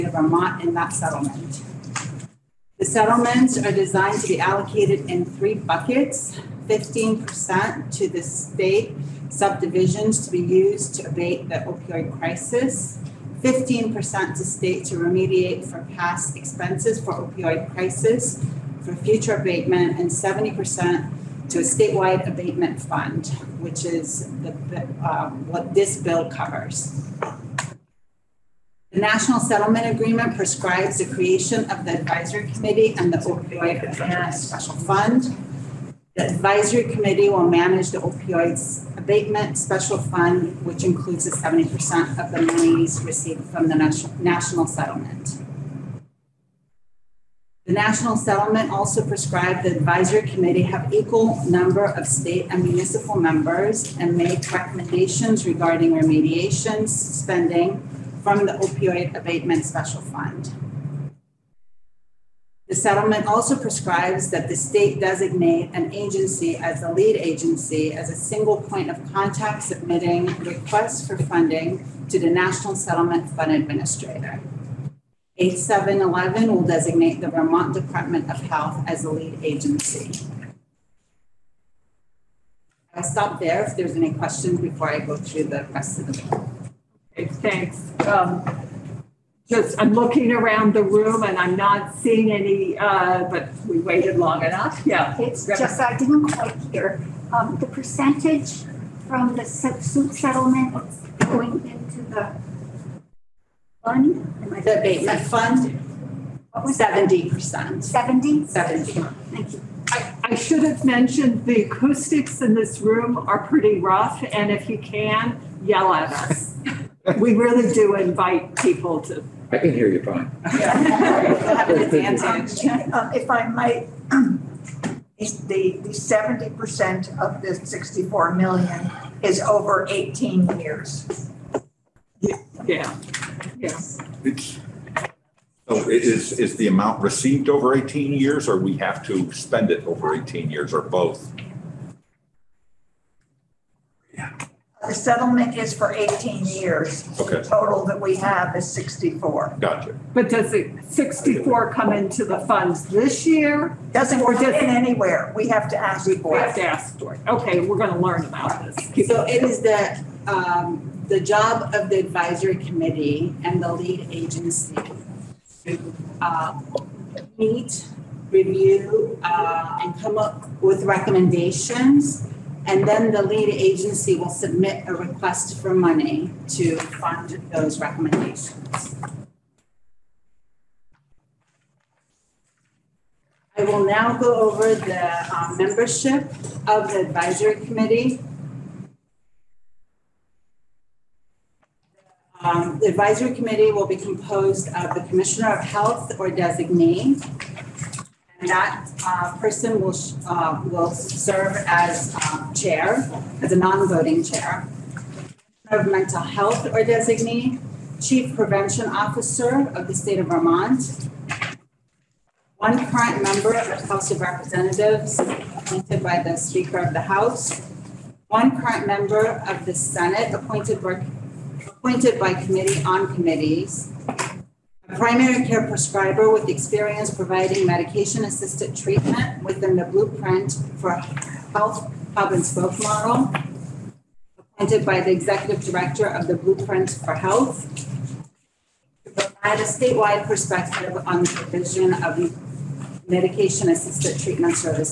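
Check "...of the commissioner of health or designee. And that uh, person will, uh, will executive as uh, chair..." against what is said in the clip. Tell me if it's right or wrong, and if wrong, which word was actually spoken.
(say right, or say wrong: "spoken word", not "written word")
wrong: "serve", not "executive".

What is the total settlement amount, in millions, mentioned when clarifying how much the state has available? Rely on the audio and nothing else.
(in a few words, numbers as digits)
64 million.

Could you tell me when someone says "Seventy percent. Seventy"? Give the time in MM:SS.
01:46.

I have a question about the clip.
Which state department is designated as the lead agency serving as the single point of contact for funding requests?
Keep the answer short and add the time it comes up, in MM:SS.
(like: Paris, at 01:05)
Vermont Department of Health, at 01:17.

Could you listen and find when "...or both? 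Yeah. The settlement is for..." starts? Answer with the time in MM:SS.
02:20.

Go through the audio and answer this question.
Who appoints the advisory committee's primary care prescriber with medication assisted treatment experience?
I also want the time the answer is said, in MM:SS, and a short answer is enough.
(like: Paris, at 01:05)
executive director of the blueprint for health, at 03:55.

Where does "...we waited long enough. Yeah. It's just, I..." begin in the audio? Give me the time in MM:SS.
01:33.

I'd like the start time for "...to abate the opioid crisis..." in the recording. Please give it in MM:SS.
00:10.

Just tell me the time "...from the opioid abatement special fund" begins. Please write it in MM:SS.
00:58.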